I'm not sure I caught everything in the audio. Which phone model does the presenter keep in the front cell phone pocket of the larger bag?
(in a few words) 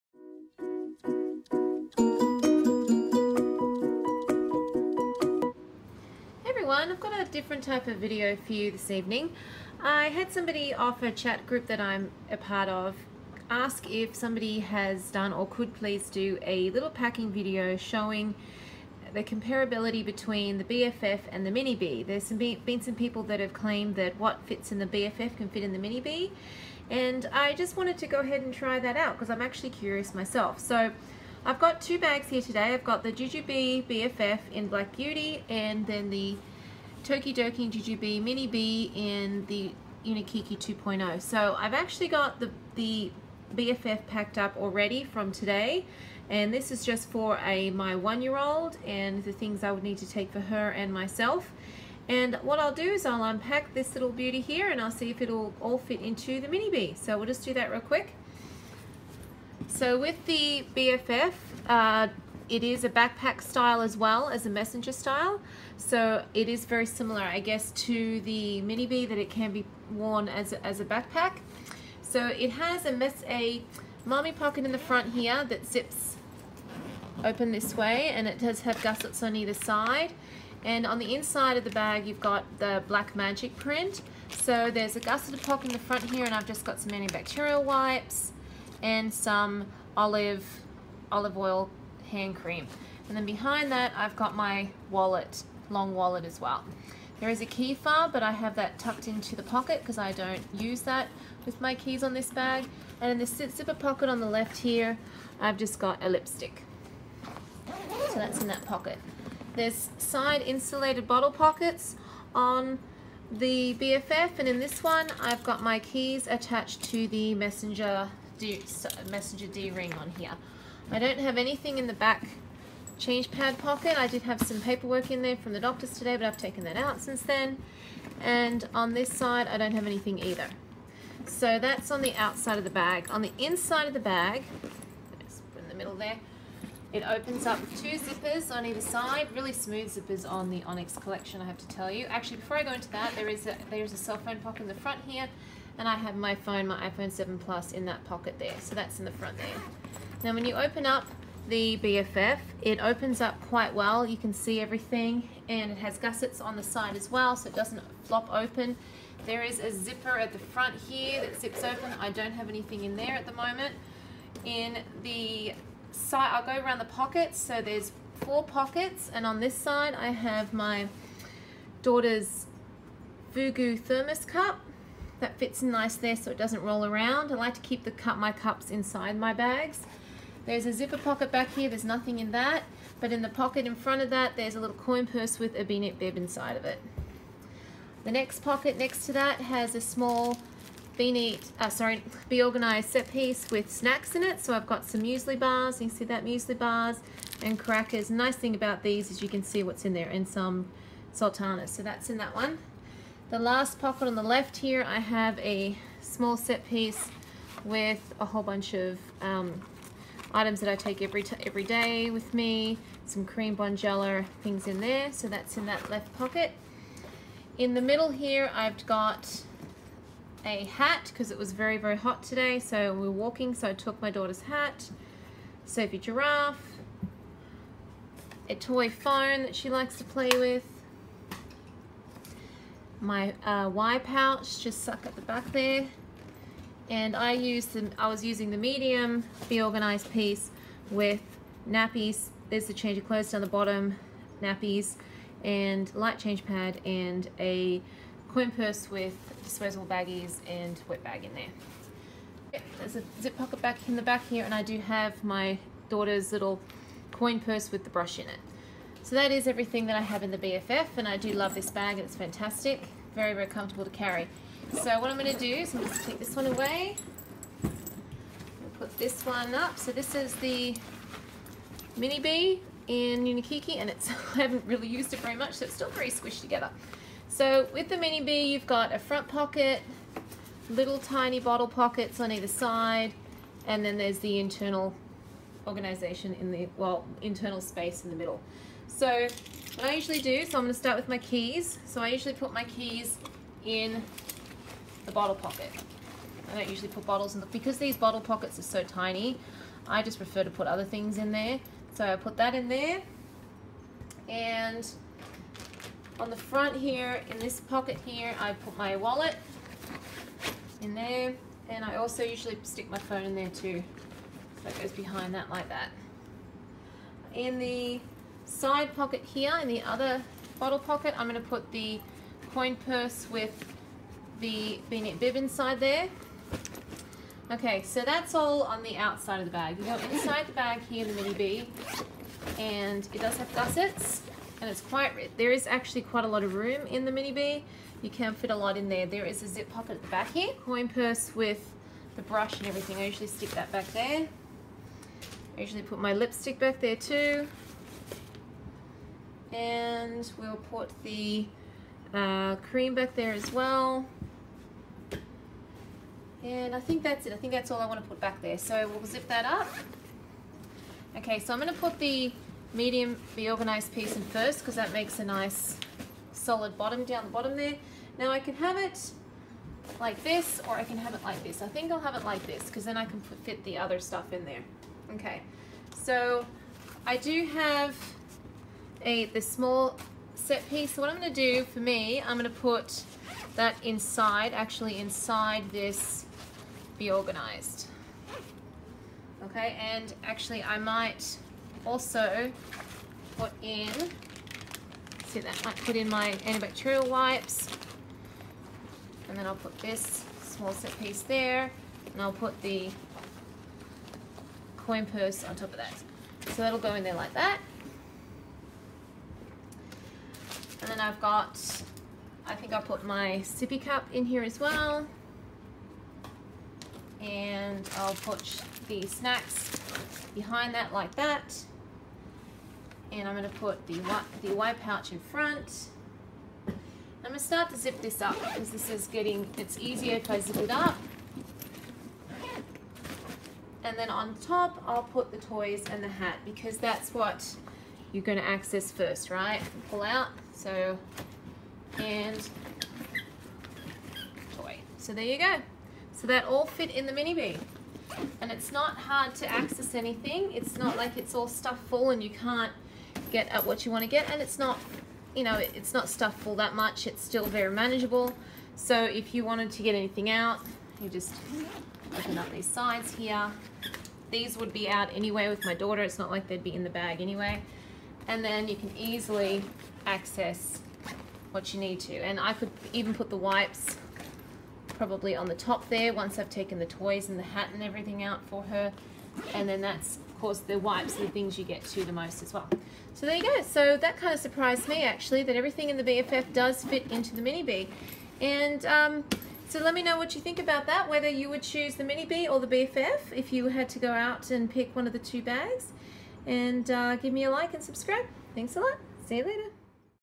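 iPhone 7 Plus.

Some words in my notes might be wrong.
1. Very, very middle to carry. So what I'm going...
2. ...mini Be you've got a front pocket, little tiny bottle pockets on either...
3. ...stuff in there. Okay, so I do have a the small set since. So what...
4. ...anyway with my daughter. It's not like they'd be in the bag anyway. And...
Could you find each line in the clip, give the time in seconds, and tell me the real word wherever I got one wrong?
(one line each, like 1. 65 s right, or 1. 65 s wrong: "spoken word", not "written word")
1. 263 s wrong: "comfortable", not "middle"
2. 277 s right
3. 373 s wrong: "piece", not "since"
4. 465 s right.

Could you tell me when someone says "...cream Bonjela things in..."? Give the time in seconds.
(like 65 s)
213 s.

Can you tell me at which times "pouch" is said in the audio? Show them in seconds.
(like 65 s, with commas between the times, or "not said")
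233 s, 424 s.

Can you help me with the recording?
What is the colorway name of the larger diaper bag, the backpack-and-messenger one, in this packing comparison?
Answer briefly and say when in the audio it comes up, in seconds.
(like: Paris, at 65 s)
Black Beauty, at 34 s.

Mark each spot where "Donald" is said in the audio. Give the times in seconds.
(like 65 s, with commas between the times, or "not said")
not said.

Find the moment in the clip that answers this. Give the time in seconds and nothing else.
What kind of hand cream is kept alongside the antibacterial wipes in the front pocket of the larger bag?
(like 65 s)
91 s.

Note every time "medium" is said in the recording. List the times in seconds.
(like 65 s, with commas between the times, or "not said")
238 s, 362 s.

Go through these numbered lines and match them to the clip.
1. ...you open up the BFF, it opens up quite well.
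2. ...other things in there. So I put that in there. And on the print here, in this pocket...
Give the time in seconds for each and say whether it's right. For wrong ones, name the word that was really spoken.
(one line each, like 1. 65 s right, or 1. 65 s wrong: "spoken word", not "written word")
1. 150 s right
2. 300 s wrong: "front", not "print".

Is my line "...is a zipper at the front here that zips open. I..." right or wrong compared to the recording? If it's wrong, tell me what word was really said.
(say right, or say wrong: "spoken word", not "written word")
right.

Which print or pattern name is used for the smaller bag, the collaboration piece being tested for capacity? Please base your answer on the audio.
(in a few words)
Unikiki 2.0.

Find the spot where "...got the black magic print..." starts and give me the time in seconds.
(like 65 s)
82 s.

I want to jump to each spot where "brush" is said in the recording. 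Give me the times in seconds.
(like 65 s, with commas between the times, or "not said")
257 s, 342 s.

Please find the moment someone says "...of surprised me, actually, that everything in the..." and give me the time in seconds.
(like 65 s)
484 s.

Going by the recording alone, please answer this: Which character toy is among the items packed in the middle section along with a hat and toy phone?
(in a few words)
Sophie Giraffe.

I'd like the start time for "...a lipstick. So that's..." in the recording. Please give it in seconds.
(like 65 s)
106 s.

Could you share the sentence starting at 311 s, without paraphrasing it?
And I also usually stick my phone in there too.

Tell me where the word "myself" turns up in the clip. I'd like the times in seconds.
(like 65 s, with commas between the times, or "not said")
30 s, 50 s.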